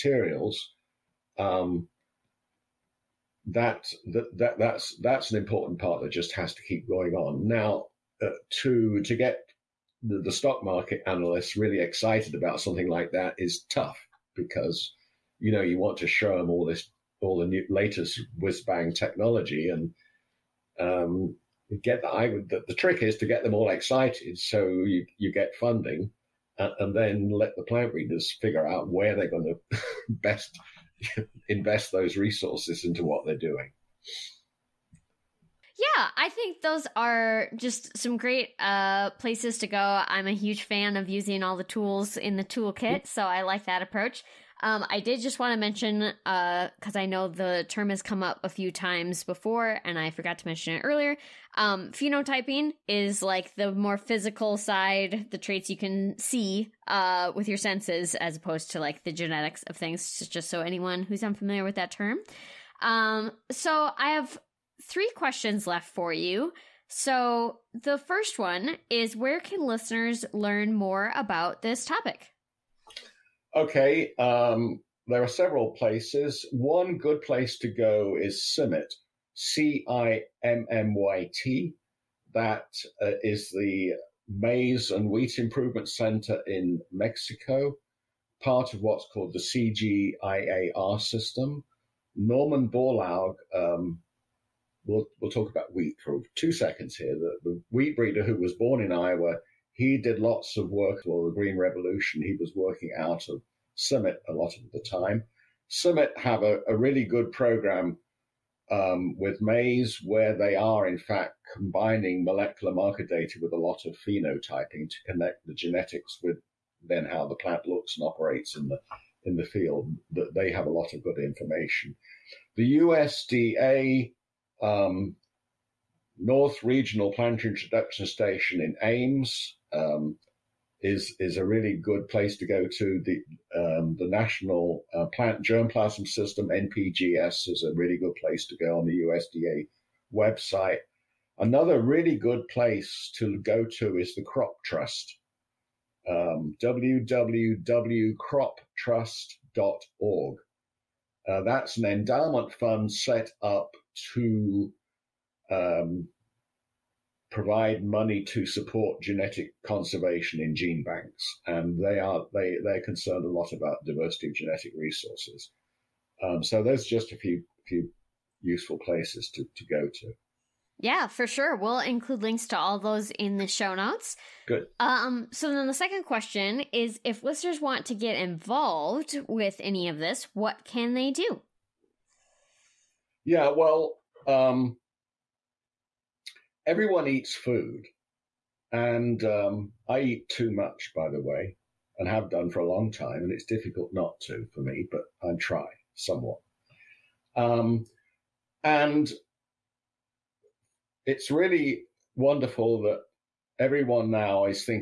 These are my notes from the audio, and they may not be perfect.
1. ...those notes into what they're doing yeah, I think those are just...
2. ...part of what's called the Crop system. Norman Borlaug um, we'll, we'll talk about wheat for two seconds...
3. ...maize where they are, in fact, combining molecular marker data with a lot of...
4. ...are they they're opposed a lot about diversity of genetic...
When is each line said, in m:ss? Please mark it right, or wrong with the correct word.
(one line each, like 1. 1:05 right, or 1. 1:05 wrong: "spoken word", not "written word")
1. 0:31 wrong: "resources", not "notes"
2. 1:28 wrong: "CGIAR", not "Crop"
3. 1:49 right
4. 2:41 wrong: "concerned", not "opposed".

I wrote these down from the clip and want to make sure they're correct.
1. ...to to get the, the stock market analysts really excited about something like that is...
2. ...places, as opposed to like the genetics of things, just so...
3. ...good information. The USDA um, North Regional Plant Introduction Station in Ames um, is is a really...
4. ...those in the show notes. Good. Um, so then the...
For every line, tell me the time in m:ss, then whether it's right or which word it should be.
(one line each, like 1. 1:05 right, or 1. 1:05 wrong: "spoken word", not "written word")
1. 0:08 right
2. 0:57 wrong: "senses", not "places"
3. 2:01 right
4. 2:52 right.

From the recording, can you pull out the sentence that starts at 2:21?
Another really good place to go to is the Crop Trust.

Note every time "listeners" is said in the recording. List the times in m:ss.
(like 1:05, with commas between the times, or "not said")
1:09, 2:57.